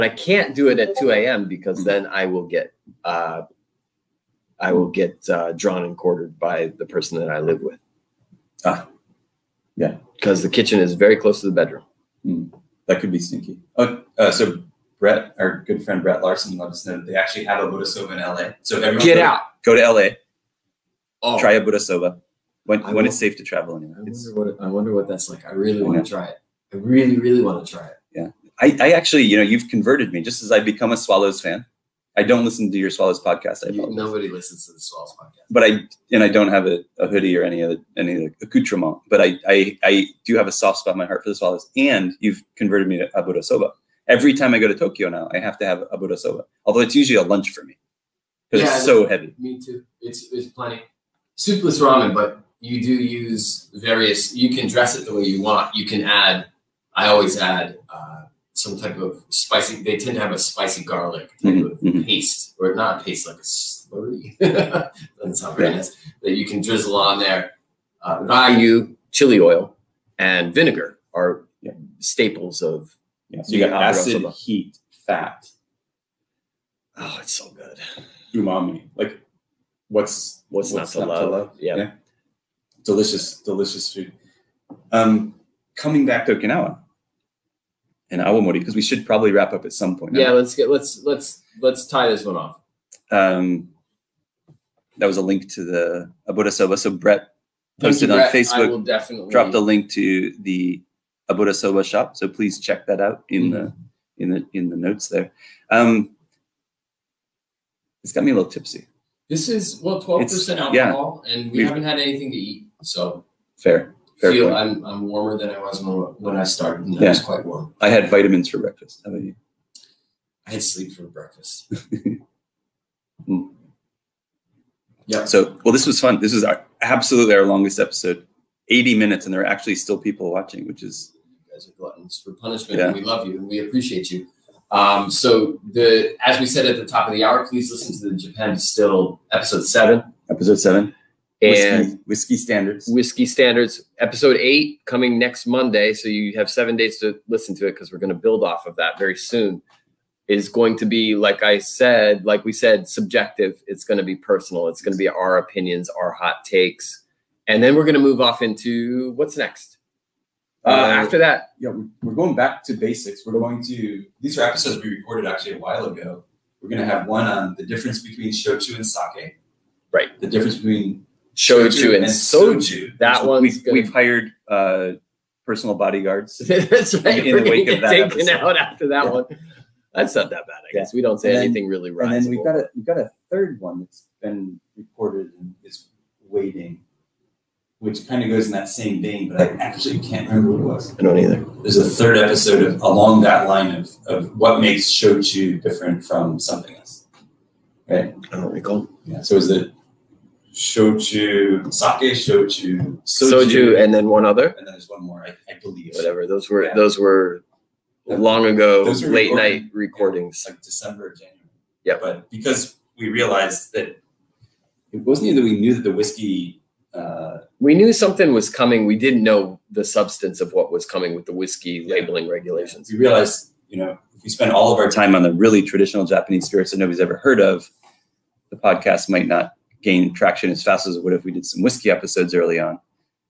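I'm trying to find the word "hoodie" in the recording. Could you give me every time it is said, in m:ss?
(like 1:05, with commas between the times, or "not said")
0:37.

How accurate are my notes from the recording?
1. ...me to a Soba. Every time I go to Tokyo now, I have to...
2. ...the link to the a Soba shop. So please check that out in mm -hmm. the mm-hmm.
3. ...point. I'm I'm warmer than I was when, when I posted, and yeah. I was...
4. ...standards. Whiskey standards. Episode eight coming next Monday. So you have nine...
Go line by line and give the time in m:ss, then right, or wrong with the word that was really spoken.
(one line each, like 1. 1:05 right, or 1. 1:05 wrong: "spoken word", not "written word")
1. 0:42 right
2. 1:39 right
3. 1:54 wrong: "started", not "posted"
4. 2:22 wrong: "seven", not "nine".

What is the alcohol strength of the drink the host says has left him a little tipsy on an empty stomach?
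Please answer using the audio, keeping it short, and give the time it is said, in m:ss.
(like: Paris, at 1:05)
12 percent, at 1:50.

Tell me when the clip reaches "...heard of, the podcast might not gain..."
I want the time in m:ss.
3:47.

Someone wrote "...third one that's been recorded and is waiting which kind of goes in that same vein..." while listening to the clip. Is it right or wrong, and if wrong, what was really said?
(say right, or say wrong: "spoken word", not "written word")
right.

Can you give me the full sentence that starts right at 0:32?
I don't listen to your Swallows podcast.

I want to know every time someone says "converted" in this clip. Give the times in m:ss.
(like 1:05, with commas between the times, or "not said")
0:29, 0:42.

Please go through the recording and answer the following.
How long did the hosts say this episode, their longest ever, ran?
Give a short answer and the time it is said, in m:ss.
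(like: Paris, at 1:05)
80 minutes, at 2:08.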